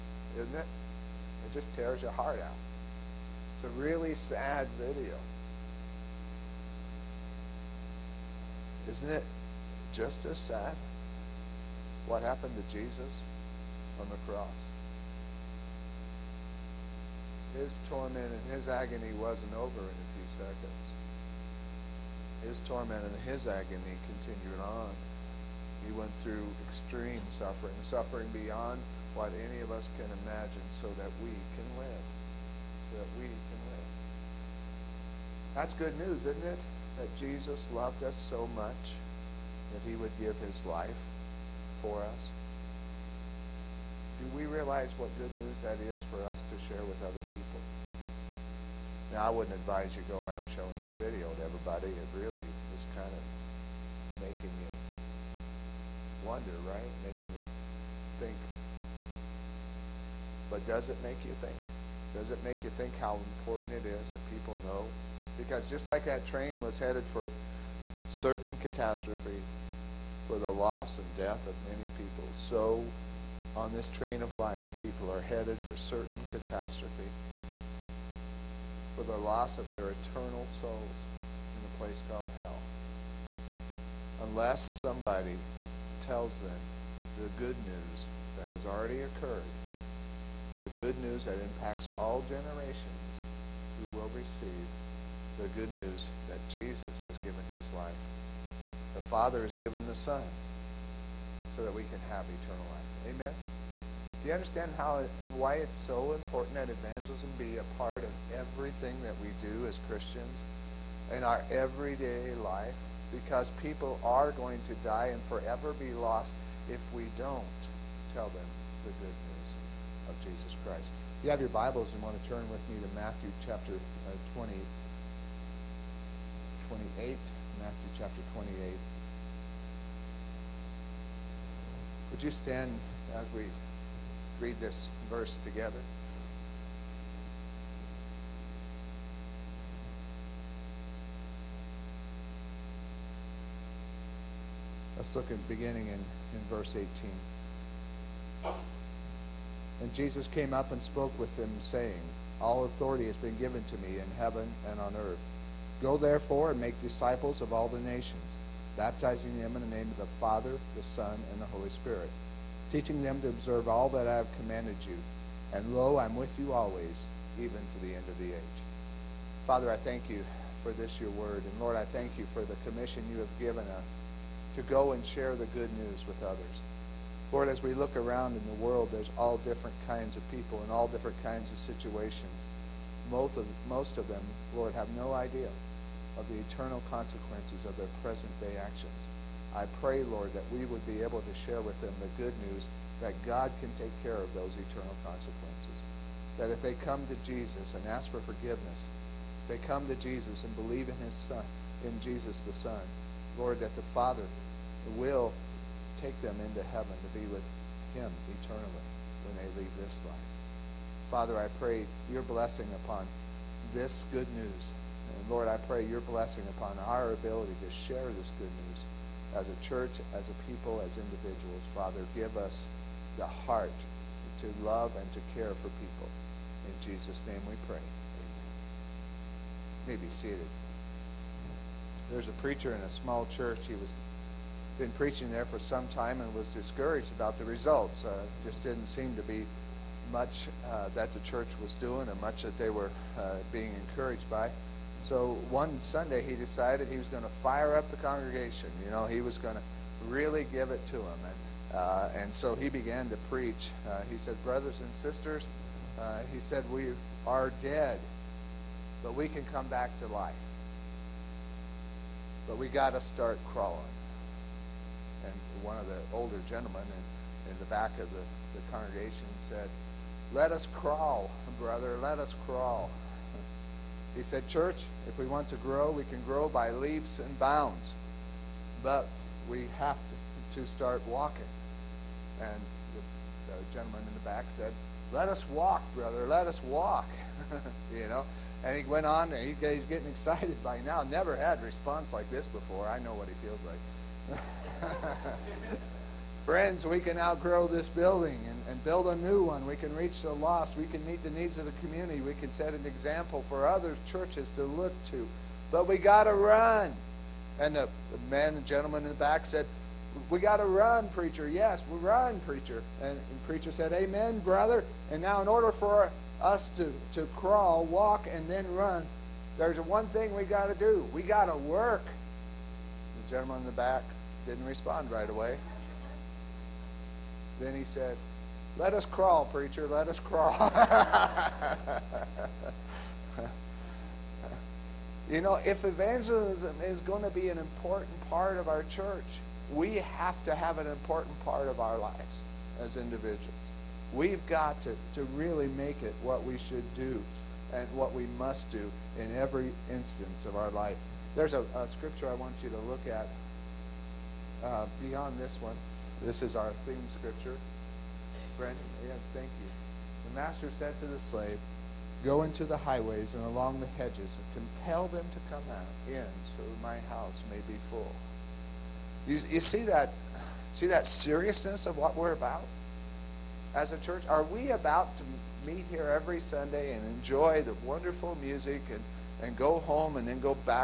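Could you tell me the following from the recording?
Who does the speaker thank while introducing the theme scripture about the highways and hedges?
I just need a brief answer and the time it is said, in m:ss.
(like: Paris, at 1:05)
Brent, at 5:58.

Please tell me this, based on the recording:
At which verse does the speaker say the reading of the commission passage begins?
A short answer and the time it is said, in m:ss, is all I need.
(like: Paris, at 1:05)
18, at 2:26.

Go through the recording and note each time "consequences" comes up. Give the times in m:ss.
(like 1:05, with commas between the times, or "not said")
3:06, 3:15.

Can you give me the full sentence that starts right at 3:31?
Father, I pray your blessing upon this good news.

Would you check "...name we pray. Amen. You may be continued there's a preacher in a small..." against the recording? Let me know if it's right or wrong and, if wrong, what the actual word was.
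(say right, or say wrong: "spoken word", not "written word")
wrong: "seated", not "continued".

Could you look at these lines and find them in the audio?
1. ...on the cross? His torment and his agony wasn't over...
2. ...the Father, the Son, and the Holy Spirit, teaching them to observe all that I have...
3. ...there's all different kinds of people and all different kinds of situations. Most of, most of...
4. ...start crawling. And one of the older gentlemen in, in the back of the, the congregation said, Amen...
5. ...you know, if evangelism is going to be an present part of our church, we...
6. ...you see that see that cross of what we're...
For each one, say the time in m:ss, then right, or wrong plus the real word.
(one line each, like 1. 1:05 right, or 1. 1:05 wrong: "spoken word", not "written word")
1. 0:13 right
2. 2:39 right
3. 2:58 right
4. 4:22 wrong: "Let", not "Amen"
5. 5:35 wrong: "important", not "present"
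6. 6:09 wrong: "seriousness", not "cross".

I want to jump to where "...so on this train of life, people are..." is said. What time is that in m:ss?
1:12.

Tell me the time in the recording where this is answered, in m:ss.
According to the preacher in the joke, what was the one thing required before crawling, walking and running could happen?
5:21.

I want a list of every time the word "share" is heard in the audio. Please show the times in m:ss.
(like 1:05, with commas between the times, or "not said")
0:46, 2:55, 3:11, 3:37.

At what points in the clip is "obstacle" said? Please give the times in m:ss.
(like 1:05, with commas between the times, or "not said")
not said.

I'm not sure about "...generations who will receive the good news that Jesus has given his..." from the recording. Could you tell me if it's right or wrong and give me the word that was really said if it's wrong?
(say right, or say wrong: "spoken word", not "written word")
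right.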